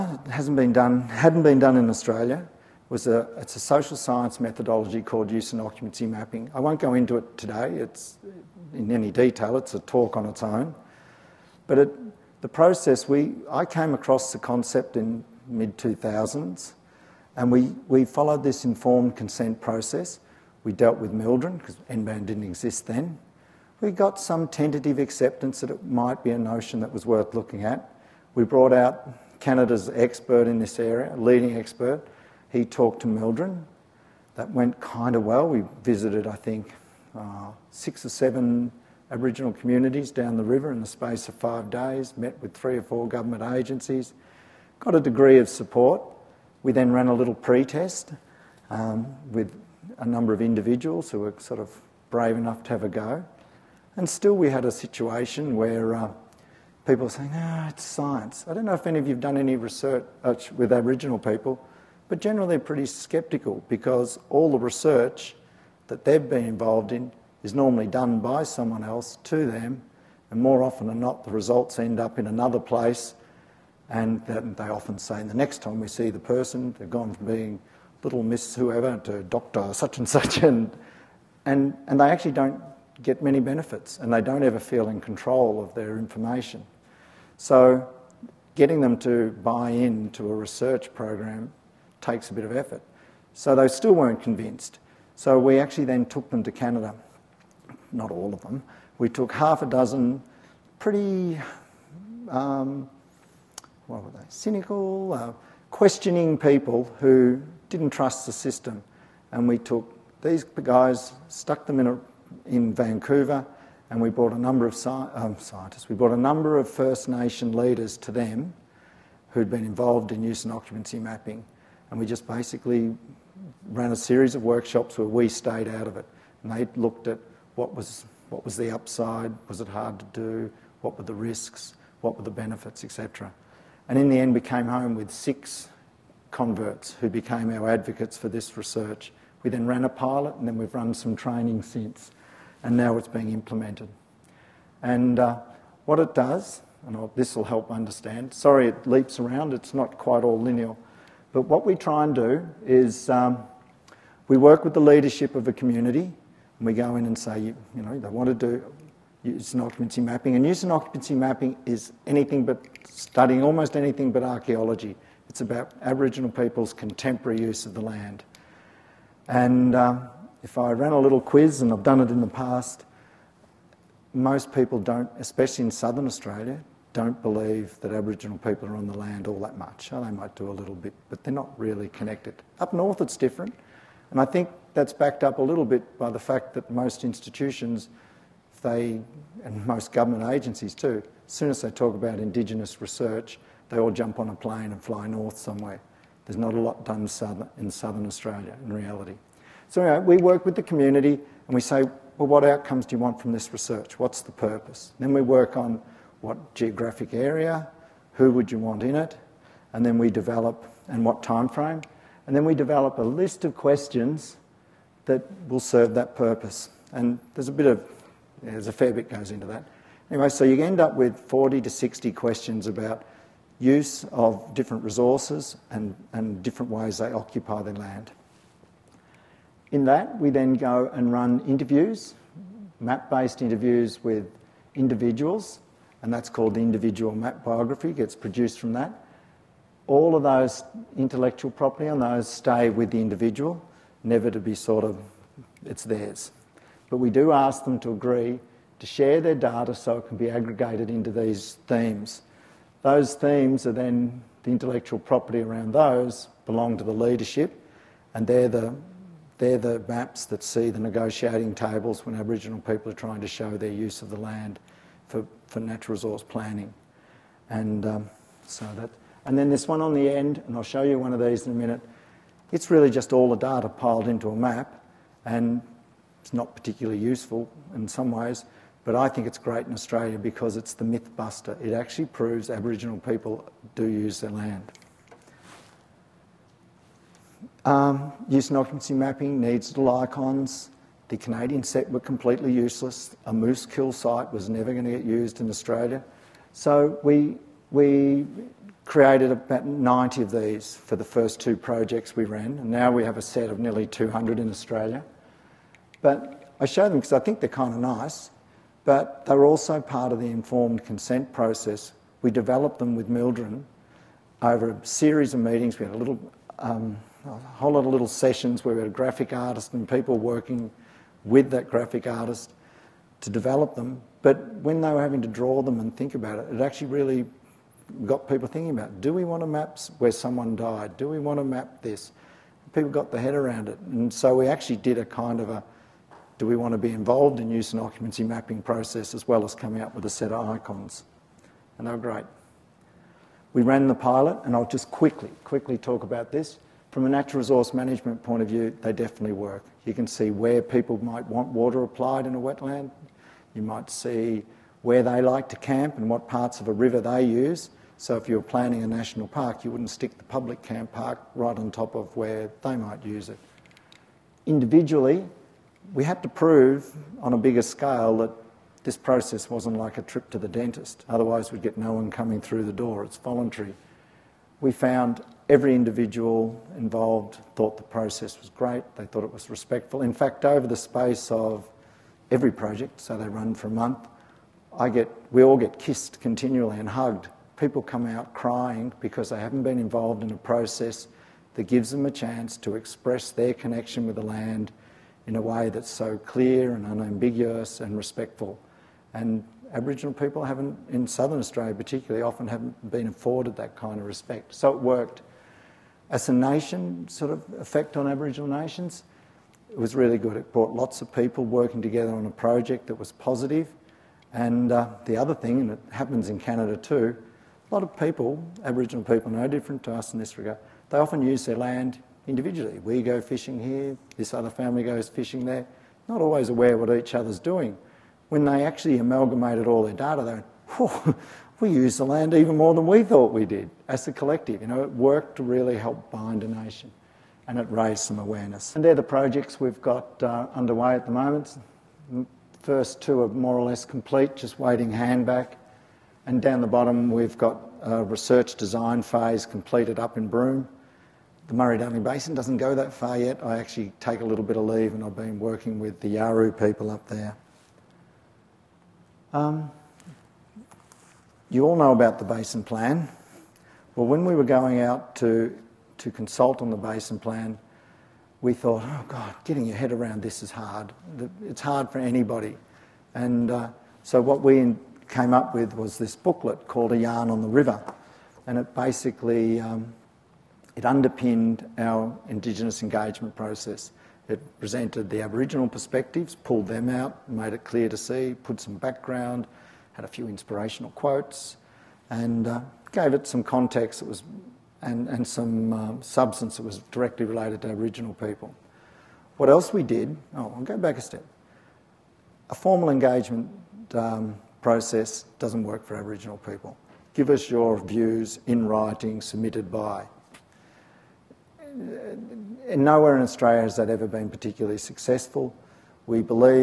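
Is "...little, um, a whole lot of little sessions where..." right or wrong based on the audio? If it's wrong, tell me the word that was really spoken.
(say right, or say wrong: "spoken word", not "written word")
right.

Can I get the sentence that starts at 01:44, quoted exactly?
Cynical, uh, questioning people who didn't trust the system.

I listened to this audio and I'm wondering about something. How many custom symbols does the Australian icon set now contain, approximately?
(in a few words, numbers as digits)
Nearly 200.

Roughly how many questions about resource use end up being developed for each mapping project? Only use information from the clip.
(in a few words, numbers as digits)
40 to 60.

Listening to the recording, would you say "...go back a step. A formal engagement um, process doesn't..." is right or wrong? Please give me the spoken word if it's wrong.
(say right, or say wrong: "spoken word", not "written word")
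right.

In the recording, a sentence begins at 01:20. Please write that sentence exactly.
And, and, and they actually don't get many benefits and they don't ever feel in control of their information.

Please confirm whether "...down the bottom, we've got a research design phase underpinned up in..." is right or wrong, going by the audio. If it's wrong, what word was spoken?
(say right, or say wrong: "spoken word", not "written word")
wrong: "completed", not "underpinned".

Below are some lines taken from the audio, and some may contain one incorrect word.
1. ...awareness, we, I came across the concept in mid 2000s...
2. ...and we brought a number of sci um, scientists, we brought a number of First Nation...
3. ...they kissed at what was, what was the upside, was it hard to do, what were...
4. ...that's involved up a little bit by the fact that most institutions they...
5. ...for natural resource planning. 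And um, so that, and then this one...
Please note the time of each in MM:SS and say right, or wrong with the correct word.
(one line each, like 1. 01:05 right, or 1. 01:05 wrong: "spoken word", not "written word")
1. 00:12 wrong: "process", not "awareness"
2. 01:53 right
3. 02:06 wrong: "looked", not "kissed"
4. 03:04 wrong: "backed", not "involved"
5. 04:25 right.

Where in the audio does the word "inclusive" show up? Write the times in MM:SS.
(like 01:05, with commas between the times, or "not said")
not said.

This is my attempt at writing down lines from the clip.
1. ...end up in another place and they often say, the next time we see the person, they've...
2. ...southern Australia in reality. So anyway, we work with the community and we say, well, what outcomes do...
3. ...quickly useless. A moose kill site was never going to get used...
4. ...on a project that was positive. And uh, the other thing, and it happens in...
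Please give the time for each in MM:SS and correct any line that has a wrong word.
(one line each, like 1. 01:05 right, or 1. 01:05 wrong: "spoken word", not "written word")
1. 01:11 right
2. 03:17 right
3. 04:52 wrong: "completely", not "quickly"
4. 06:52 right.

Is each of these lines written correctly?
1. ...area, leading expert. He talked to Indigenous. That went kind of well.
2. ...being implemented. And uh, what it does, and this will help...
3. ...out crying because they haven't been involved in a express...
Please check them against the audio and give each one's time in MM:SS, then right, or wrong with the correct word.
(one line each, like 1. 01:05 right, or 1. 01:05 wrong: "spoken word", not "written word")
1. 00:30 wrong: "MLDRIN", not "Indigenous"
2. 02:23 right
3. 06:28 wrong: "process", not "express".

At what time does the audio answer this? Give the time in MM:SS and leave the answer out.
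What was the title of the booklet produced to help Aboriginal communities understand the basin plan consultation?
07:56.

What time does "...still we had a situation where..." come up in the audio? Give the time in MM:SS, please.
00:54.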